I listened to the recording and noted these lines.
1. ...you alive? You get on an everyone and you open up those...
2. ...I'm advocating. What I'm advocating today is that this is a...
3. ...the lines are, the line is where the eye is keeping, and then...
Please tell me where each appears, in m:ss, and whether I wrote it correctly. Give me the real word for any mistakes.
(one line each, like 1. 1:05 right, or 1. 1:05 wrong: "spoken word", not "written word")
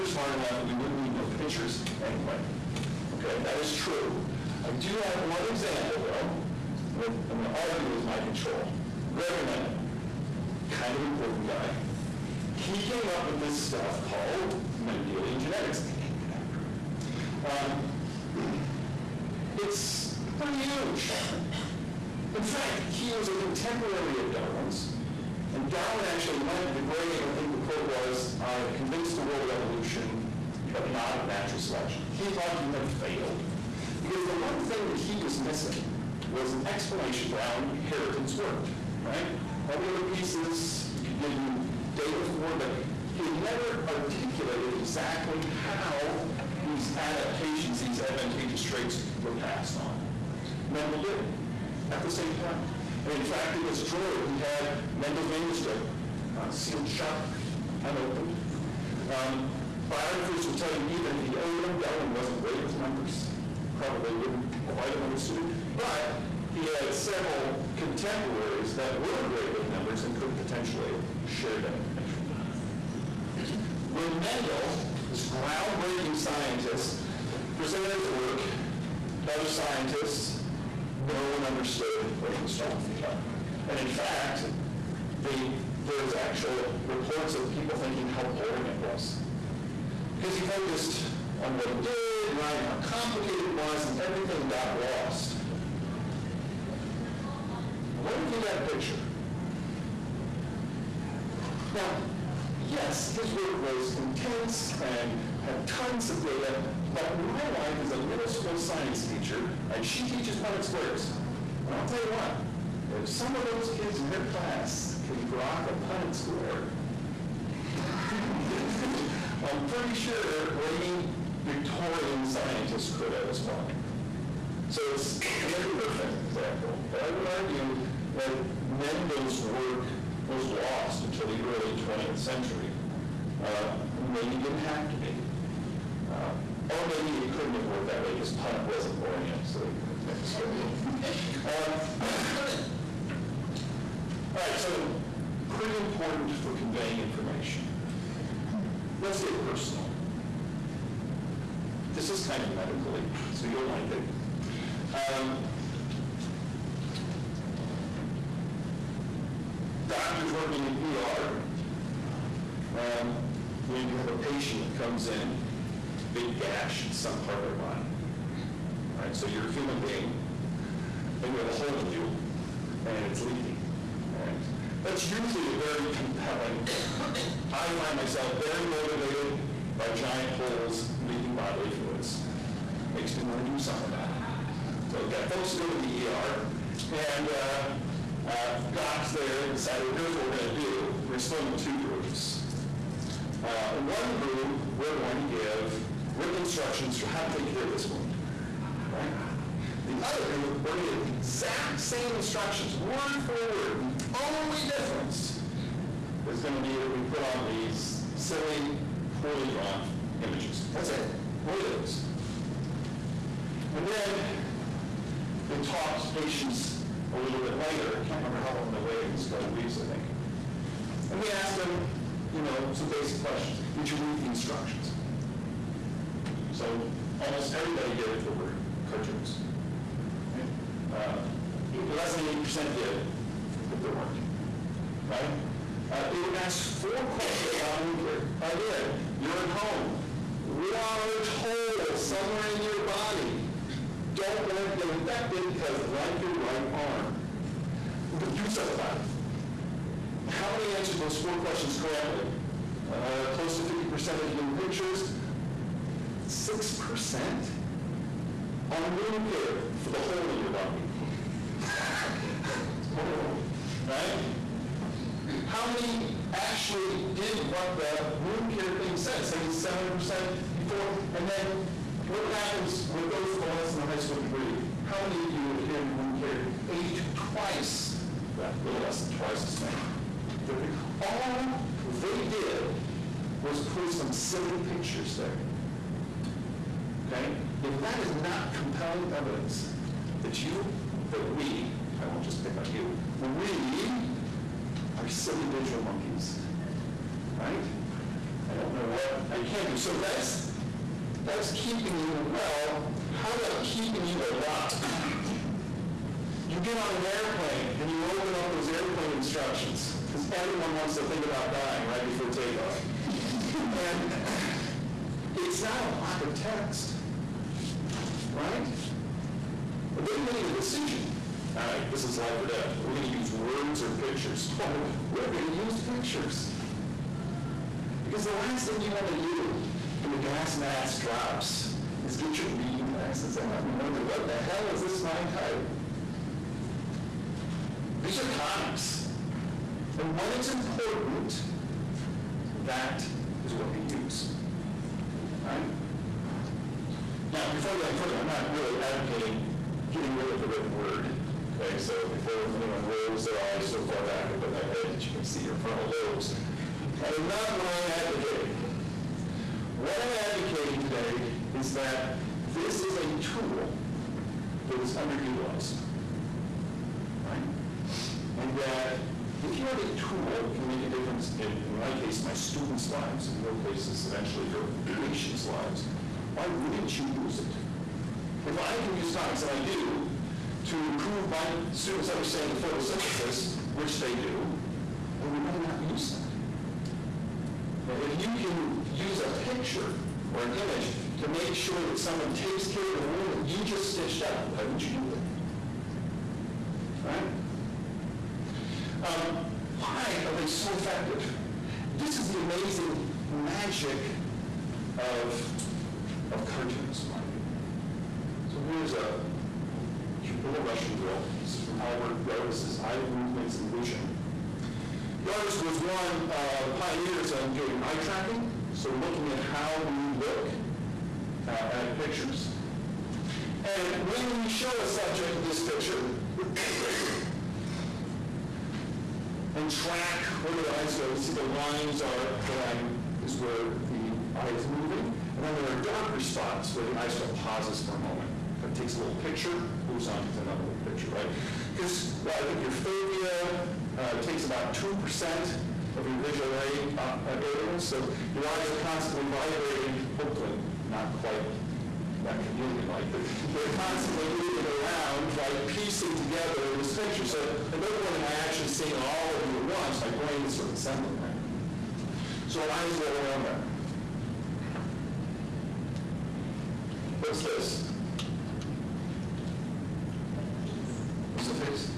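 1. 5:04 wrong: "airplane", not "everyone"
2. 5:57 right
3. 7:11 wrong: "moving", not "keeping".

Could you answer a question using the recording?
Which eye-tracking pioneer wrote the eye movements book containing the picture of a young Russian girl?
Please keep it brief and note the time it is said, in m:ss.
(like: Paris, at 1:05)
Albert Yarbus, at 6:51.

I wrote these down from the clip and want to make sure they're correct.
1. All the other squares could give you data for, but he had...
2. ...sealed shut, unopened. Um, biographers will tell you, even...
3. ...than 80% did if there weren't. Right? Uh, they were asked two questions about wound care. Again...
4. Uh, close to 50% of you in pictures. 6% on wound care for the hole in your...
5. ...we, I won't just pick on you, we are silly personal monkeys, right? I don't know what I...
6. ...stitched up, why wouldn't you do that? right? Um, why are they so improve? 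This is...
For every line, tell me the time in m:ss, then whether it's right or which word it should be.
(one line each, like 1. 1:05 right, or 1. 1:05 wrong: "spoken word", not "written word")
1. 0:39 wrong: "pieces", not "squares"
2. 0:56 right
3. 3:52 wrong: "four", not "two"
4. 4:12 right
5. 4:51 wrong: "visual", not "personal"
6. 6:33 wrong: "effective", not "improve".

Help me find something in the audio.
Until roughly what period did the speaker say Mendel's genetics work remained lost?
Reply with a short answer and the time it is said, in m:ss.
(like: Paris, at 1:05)
early 20th century, at 2:11.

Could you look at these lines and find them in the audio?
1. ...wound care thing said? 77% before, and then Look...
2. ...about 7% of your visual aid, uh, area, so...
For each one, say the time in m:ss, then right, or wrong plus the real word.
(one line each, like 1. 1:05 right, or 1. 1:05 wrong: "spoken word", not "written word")
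1. 4:28 right
2. 7:24 wrong: "2", not "7".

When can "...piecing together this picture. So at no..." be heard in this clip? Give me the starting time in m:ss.
7:35.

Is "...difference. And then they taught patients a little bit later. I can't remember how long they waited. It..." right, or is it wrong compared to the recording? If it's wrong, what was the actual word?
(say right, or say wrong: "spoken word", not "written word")
right.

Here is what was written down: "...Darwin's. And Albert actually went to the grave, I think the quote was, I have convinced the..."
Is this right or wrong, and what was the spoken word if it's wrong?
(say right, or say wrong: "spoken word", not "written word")
wrong: "Darwin", not "Albert".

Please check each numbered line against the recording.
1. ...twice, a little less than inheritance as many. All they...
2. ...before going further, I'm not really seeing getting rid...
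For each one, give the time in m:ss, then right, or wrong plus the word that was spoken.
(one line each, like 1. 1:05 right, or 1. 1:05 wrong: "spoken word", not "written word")
1. 4:37 wrong: "twice", not "inheritance"
2. 5:47 wrong: "advocating", not "seeing".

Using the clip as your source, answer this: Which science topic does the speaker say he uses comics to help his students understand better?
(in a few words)
photosynthesis.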